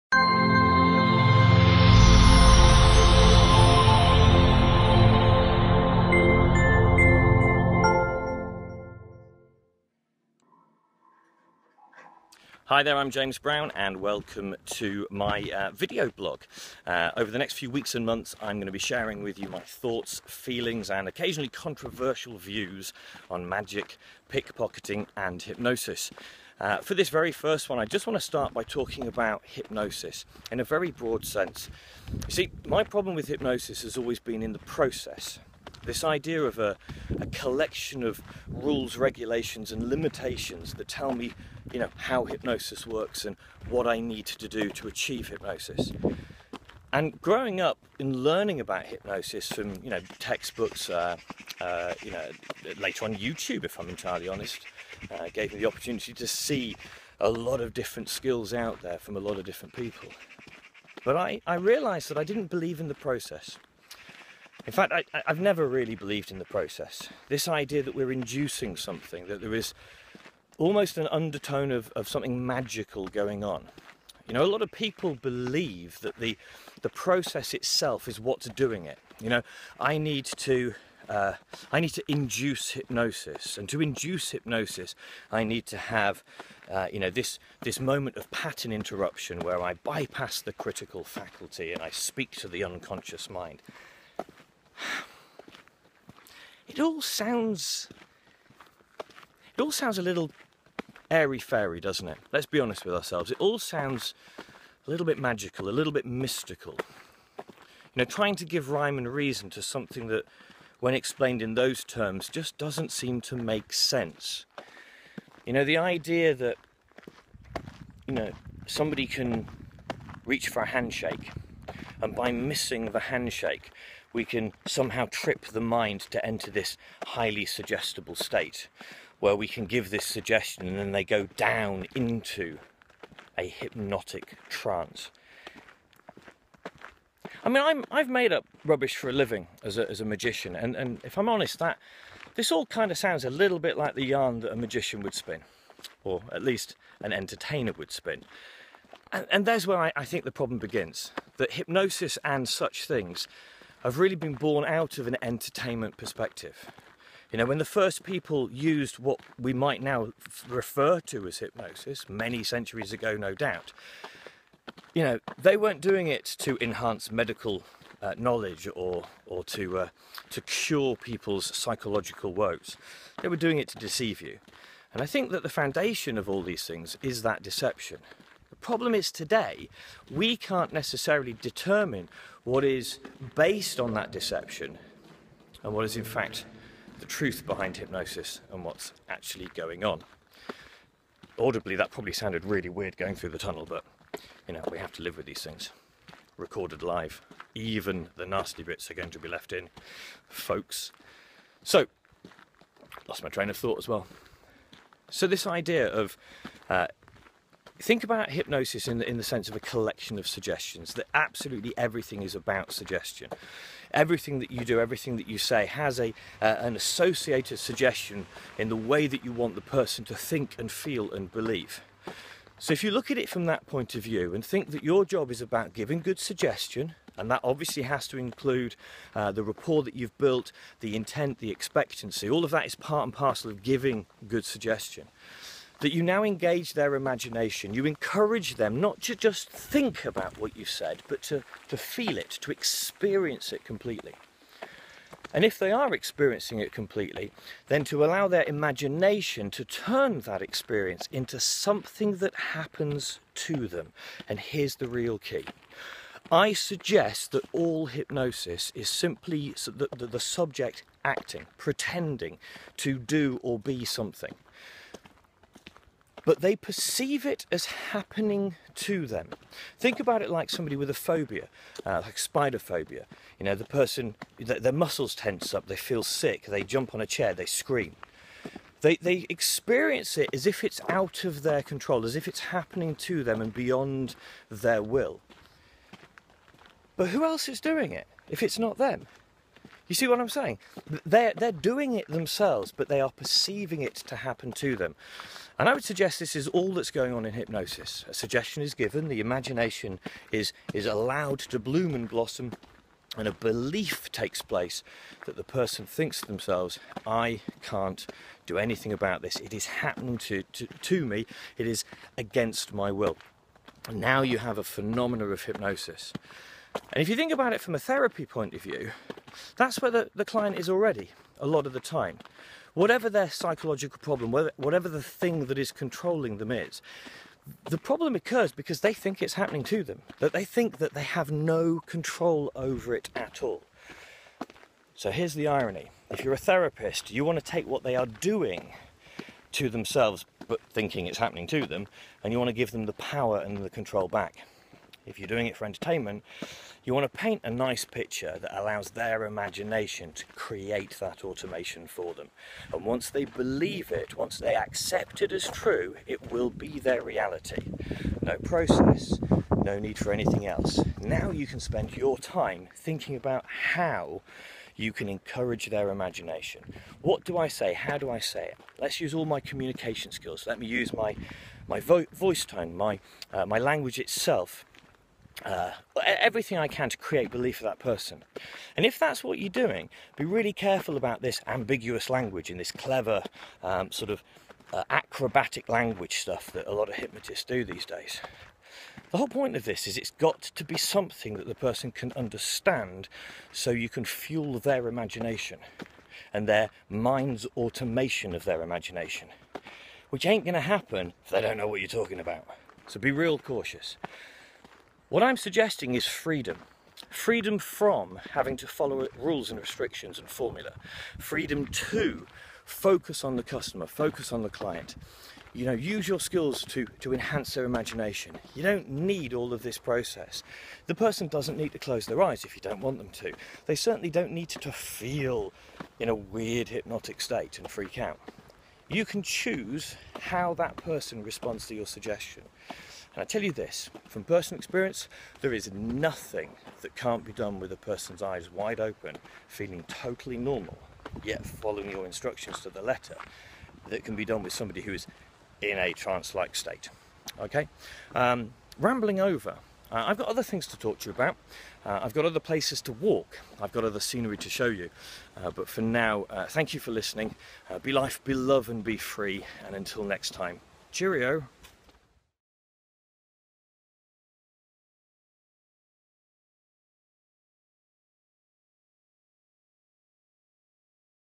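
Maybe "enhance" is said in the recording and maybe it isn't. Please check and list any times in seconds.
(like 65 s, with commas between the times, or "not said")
166 s, 417 s.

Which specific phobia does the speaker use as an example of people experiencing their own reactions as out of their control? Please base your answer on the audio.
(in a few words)
spider phobia.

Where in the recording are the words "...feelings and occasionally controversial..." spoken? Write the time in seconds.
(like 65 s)
20 s.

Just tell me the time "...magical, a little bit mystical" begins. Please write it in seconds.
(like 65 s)
105 s.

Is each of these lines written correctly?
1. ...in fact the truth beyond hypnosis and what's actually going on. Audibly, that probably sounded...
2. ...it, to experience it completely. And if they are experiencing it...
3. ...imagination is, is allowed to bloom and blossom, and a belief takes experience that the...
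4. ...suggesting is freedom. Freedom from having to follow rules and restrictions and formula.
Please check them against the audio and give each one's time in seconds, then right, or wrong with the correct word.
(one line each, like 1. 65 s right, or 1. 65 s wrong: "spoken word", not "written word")
1. 185 s wrong: "behind", not "beyond"
2. 242 s right
3. 299 s wrong: "place", not "experience"
4. 405 s right.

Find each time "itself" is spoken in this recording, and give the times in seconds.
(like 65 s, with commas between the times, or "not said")
77 s, 373 s.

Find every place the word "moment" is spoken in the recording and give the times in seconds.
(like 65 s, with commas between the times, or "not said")
87 s.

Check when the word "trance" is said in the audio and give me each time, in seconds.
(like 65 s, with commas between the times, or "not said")
134 s, 445 s.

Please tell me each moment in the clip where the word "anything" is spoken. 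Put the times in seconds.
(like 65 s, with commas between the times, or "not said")
308 s, 360 s.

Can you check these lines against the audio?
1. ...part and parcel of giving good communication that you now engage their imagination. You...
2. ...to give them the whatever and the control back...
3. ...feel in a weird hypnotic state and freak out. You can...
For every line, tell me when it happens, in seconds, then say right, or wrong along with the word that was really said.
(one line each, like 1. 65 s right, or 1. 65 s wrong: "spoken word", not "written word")
1. 232 s wrong: "suggestion", not "communication"
2. 342 s wrong: "power", not "whatever"
3. 424 s right.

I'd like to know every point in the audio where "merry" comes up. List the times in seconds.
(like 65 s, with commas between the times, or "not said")
not said.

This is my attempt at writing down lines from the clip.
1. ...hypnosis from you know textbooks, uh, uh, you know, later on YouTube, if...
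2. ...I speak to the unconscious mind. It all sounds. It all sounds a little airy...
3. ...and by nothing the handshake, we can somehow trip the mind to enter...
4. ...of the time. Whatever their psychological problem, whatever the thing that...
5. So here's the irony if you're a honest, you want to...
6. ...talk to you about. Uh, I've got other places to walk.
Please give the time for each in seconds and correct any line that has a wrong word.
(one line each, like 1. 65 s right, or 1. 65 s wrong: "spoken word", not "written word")
1. 48 s right
2. 91 s right
3. 122 s wrong: "missing", not "nothing"
4. 321 s right
5. 334 s wrong: "therapist", not "honest"
6. 450 s right.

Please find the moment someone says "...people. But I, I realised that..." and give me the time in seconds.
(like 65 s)
59 s.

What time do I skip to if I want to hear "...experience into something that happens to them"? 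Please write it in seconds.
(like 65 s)
250 s.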